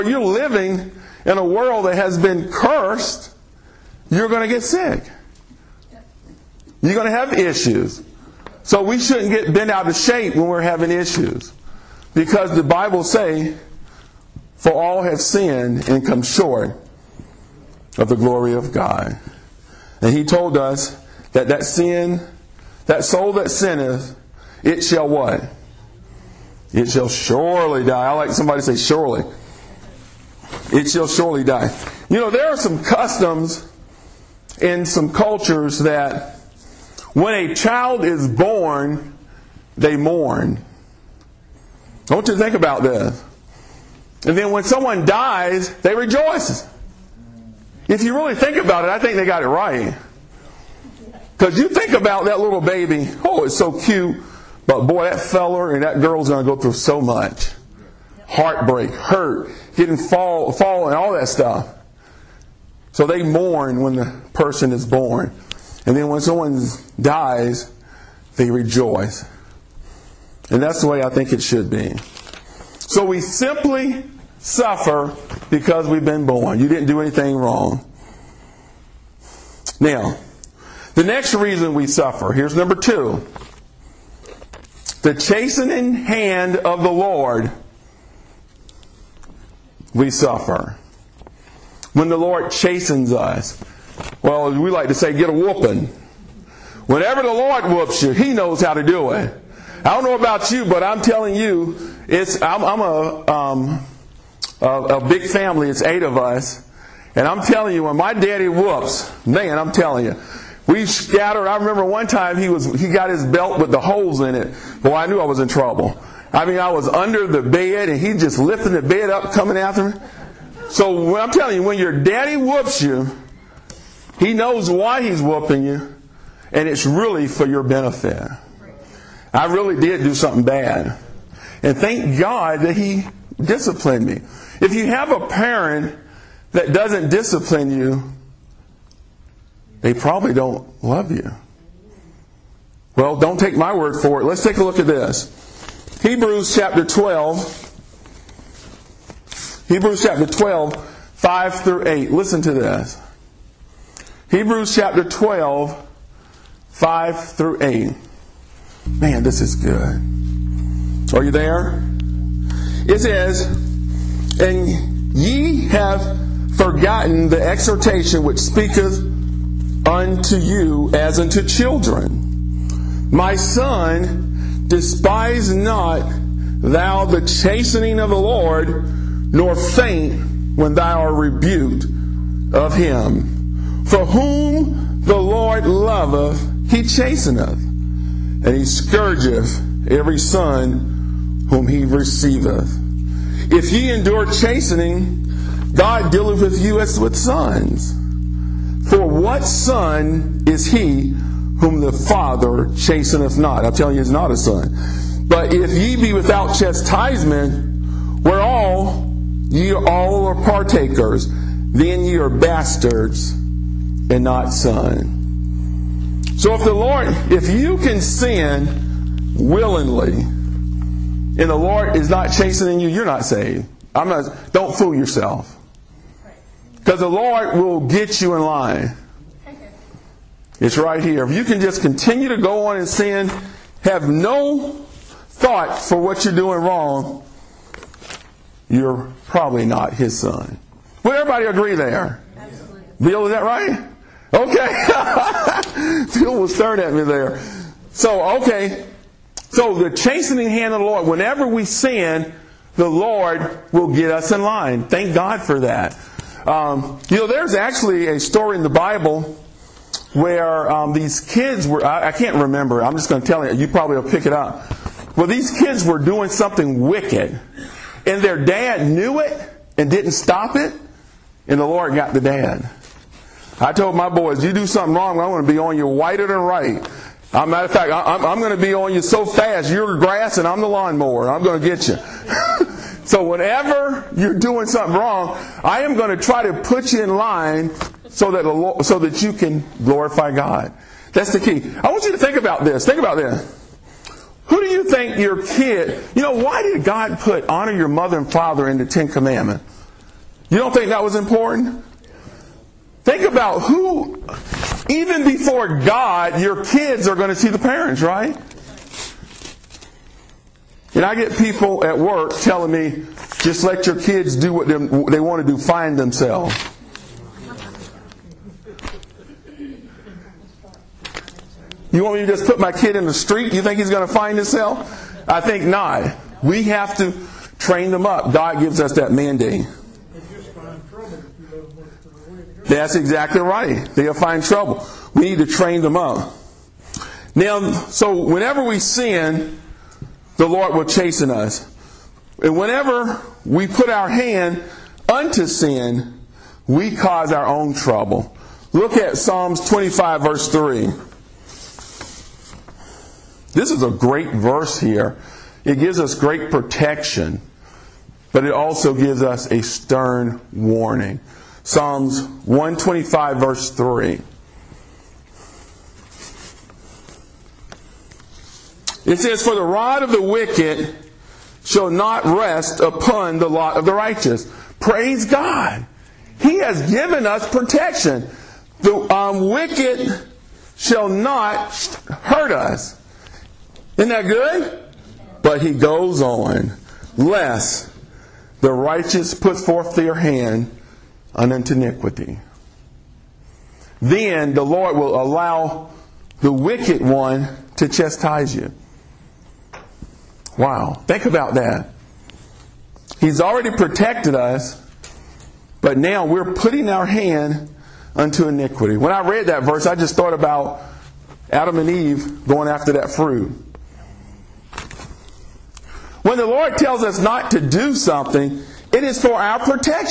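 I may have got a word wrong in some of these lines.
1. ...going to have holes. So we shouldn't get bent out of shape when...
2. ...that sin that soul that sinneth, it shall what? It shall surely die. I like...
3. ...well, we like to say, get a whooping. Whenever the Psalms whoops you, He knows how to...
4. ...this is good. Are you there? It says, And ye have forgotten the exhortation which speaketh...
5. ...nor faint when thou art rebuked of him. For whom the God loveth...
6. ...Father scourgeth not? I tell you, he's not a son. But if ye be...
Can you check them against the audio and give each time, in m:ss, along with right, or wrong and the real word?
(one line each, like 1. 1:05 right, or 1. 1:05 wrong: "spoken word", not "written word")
1. 0:06 wrong: "issues", not "holes"
2. 0:21 right
3. 1:34 wrong: "Lord", not "Psalms"
4. 2:39 right
5. 2:59 wrong: "Lord", not "God"
6. 3:21 wrong: "chasteneth", not "scourgeth".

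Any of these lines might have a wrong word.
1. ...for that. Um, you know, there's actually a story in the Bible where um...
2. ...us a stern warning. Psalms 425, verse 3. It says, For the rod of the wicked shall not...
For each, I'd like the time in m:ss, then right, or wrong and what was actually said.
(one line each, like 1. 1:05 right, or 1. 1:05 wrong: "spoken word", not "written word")
1. 4:15 right
2. 5:59 wrong: "125", not "425".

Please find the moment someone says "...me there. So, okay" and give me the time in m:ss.
4:06.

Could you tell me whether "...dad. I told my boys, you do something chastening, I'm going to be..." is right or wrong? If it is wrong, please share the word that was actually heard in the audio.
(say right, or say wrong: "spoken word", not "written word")
wrong: "wrong", not "chastening".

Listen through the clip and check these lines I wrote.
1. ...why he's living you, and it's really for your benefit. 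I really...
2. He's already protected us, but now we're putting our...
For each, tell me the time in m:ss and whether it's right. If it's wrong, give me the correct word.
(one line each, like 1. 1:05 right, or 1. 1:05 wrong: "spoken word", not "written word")
1. 2:04 wrong: "whooping", not "living"
2. 6:43 right.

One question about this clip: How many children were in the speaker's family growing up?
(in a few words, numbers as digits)
8.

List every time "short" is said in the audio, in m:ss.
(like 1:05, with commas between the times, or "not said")
0:16.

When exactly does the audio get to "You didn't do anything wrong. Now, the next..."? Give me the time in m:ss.
1:16.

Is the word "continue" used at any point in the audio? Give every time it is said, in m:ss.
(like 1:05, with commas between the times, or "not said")
3:51.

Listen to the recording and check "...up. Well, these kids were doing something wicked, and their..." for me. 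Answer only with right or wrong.
right.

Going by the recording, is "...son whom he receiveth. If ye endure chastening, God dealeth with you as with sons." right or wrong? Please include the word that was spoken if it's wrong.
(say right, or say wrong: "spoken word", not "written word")
right.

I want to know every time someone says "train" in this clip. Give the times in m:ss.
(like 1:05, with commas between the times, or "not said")
5:27, 5:35.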